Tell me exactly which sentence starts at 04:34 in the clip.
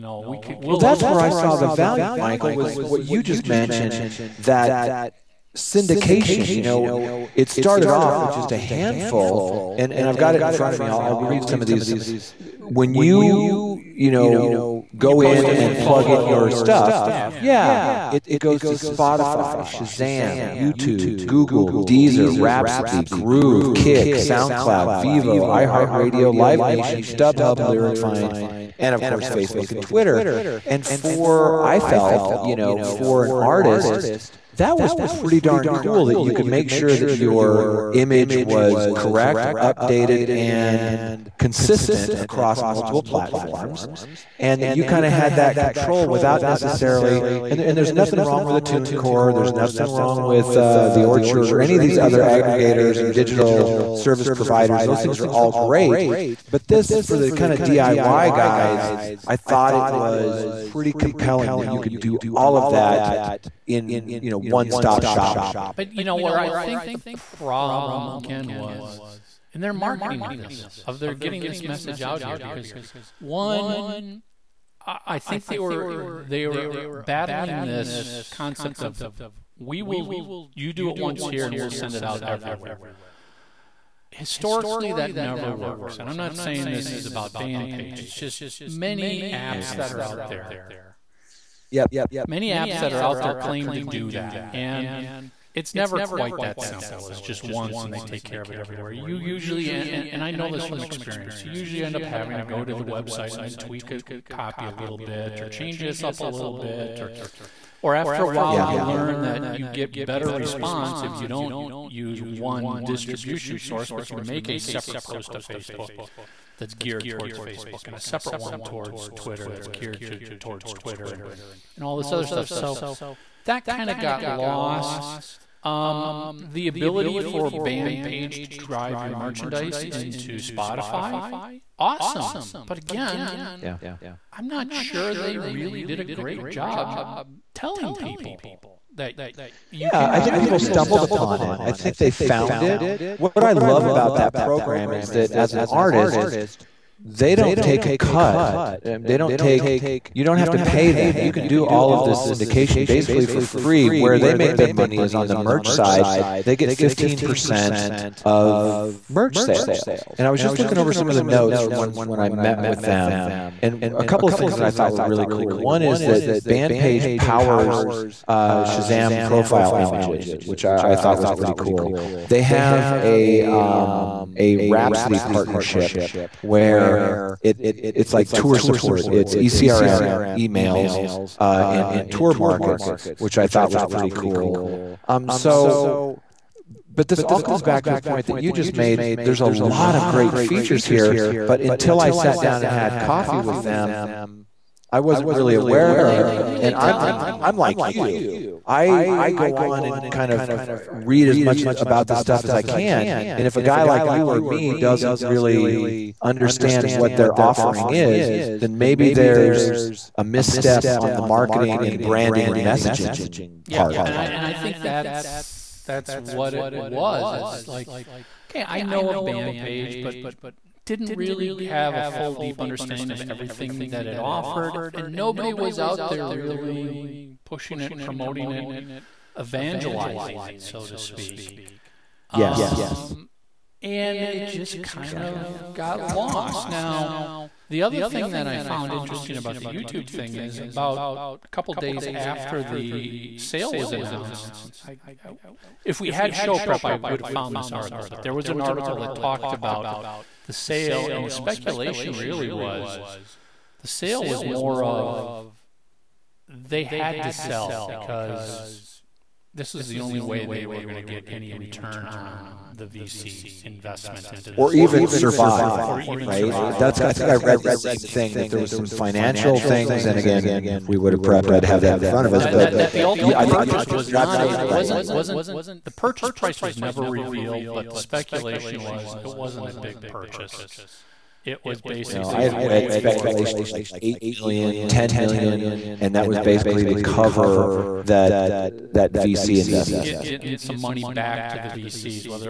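wasn't wasn't the purchase price was never revealed, but the speculation was it wasn't a big purchase.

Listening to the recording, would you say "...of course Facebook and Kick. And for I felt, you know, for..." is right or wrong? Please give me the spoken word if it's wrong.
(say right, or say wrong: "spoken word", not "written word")
wrong: "Twitter", not "Kick".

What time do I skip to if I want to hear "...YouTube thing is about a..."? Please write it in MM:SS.
03:59.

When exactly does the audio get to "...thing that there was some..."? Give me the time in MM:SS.
04:27.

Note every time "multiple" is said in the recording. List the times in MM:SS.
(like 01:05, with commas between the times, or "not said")
00:42.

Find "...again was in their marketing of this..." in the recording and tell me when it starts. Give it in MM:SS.
01:08.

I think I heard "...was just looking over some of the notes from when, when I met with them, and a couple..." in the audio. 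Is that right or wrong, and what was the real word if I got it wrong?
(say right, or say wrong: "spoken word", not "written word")
right.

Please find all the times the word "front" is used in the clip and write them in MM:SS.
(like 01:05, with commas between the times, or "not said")
00:10, 04:32.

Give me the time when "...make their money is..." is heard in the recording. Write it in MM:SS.
02:34.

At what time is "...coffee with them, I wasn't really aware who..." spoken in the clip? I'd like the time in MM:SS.
03:12.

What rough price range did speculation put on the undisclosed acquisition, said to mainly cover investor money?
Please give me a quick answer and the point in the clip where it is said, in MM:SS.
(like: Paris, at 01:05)
8 million to 10 million, at 04:43.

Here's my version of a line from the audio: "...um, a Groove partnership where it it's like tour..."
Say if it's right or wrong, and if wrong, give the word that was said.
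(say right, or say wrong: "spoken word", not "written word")
wrong: "Rhapsody", not "Groove".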